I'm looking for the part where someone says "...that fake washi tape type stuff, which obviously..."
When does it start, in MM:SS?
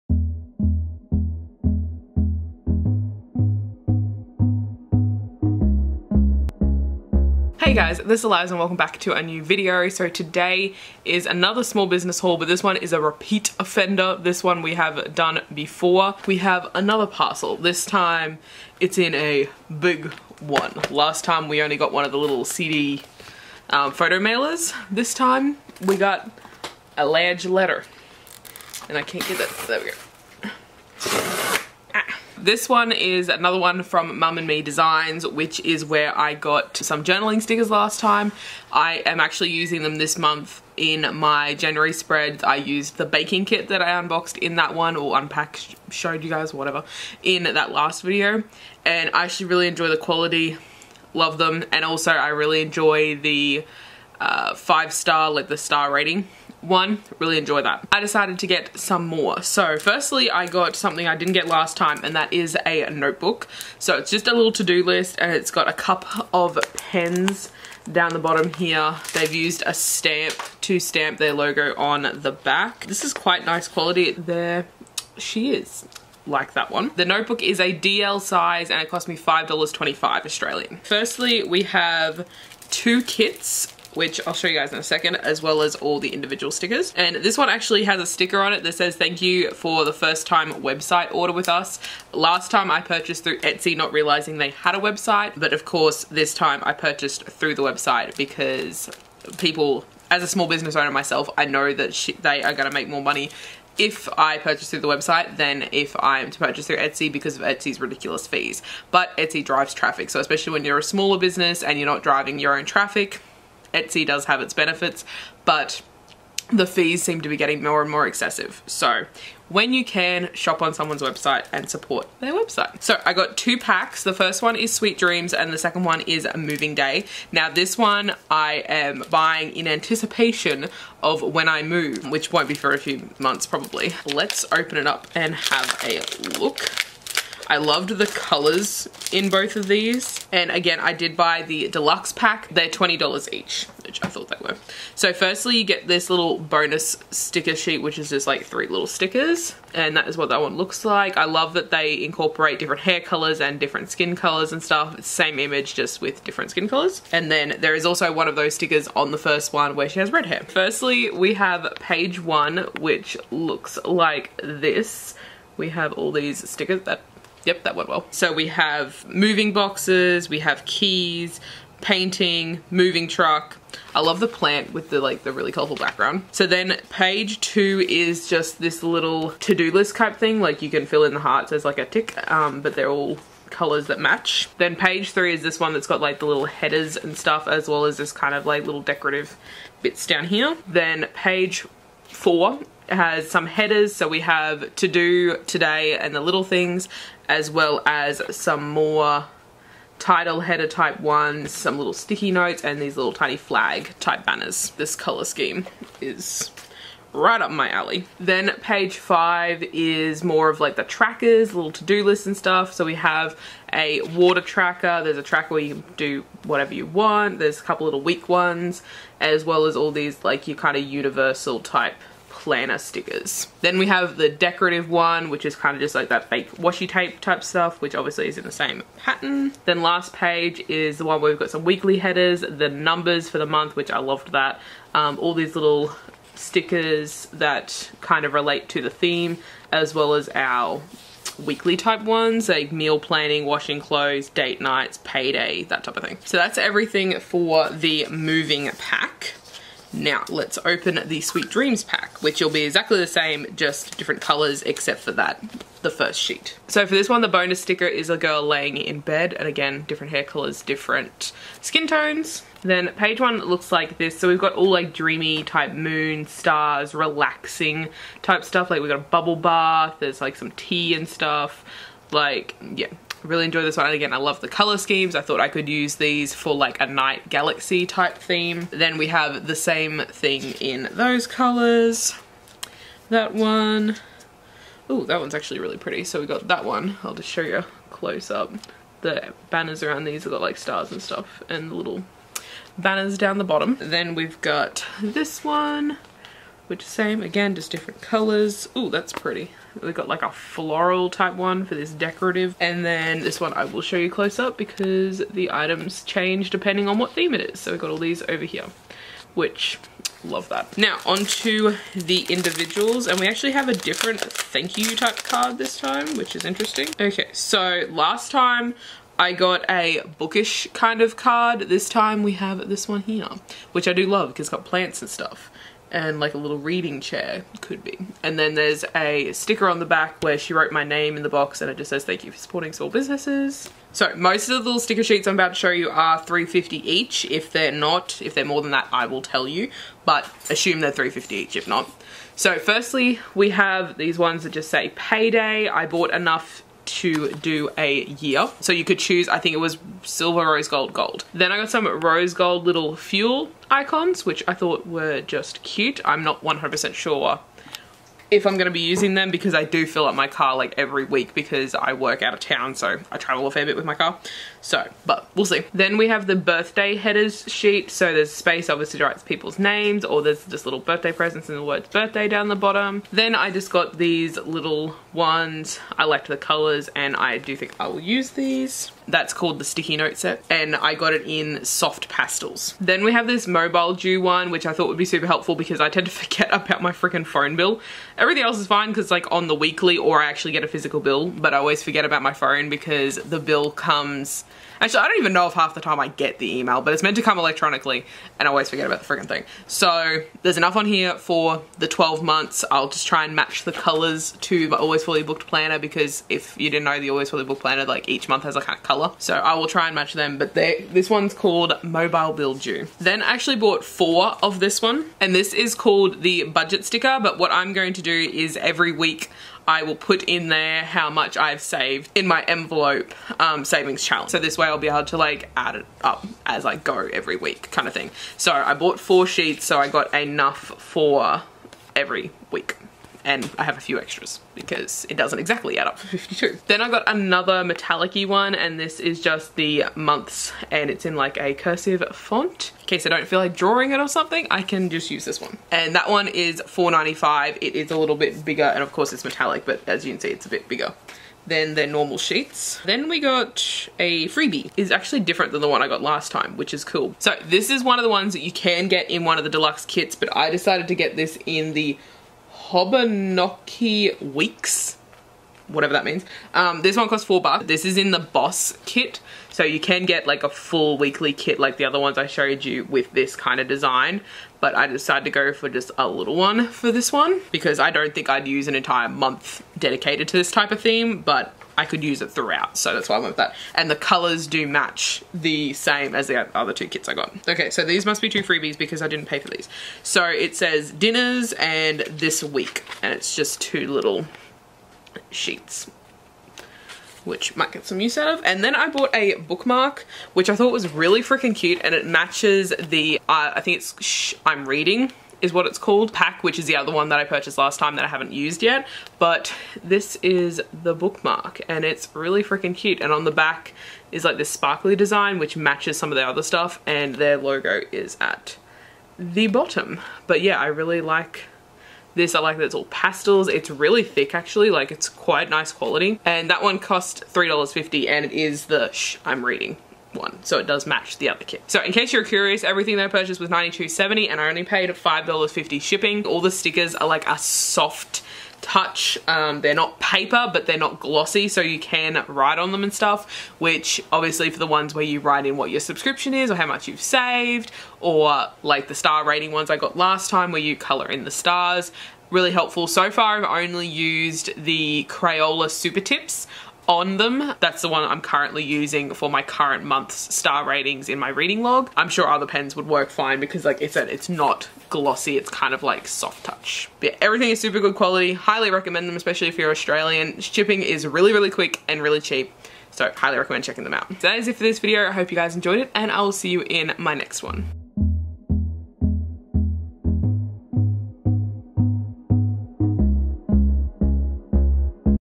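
03:46.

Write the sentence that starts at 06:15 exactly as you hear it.
I liked the colors and I do think I will use these.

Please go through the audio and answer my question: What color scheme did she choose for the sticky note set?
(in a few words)
soft pastels.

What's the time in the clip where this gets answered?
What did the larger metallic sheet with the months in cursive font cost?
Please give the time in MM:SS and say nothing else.
07:26.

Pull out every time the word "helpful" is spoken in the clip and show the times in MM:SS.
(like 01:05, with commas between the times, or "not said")
06:25, 09:12.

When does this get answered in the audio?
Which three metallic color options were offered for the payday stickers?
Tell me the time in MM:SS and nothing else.
05:50.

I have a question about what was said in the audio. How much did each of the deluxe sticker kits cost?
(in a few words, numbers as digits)
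$20.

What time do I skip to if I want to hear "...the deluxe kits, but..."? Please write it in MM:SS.
07:39.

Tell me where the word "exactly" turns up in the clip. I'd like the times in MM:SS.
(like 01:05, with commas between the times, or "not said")
04:12, 07:15.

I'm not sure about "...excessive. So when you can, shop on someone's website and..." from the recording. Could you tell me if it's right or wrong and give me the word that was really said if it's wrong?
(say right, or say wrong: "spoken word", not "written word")
right.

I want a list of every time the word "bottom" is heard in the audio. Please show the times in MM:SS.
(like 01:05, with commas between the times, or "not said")
01:08, 04:53, 06:12, 08:39.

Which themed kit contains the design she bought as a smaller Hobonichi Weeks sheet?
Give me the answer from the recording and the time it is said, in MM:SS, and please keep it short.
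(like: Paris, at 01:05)
the boss kit, at 07:48.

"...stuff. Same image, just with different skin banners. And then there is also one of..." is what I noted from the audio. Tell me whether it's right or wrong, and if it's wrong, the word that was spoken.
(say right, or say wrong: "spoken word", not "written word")
wrong: "colors", not "banners".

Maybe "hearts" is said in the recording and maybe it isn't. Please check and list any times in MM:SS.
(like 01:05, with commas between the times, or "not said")
03:01.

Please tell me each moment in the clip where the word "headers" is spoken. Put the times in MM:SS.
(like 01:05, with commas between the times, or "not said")
03:06, 03:13, 03:20, 03:51, 06:06.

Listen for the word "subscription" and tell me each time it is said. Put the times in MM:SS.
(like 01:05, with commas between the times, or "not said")
09:05.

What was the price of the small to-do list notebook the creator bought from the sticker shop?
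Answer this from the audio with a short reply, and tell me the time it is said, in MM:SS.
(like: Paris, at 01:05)
$5.25, at 01:19.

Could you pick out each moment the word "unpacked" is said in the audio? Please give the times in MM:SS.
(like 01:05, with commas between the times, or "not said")
00:45.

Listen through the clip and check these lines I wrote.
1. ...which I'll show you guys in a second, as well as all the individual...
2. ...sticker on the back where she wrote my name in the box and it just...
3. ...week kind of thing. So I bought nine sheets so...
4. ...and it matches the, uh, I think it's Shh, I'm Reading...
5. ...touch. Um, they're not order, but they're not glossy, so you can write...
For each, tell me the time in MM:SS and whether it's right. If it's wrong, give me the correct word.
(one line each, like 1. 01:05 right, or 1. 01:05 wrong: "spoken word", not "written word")
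1. 01:23 right
2. 05:29 right
3. 07:07 wrong: "four", not "nine"
4. 08:21 right
5. 08:58 wrong: "paper", not "order".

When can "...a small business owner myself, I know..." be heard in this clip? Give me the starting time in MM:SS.
01:40.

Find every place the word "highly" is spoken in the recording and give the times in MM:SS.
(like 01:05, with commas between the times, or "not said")
09:28, 09:33.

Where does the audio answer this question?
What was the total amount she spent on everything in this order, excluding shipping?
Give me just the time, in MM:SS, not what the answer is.
08:53.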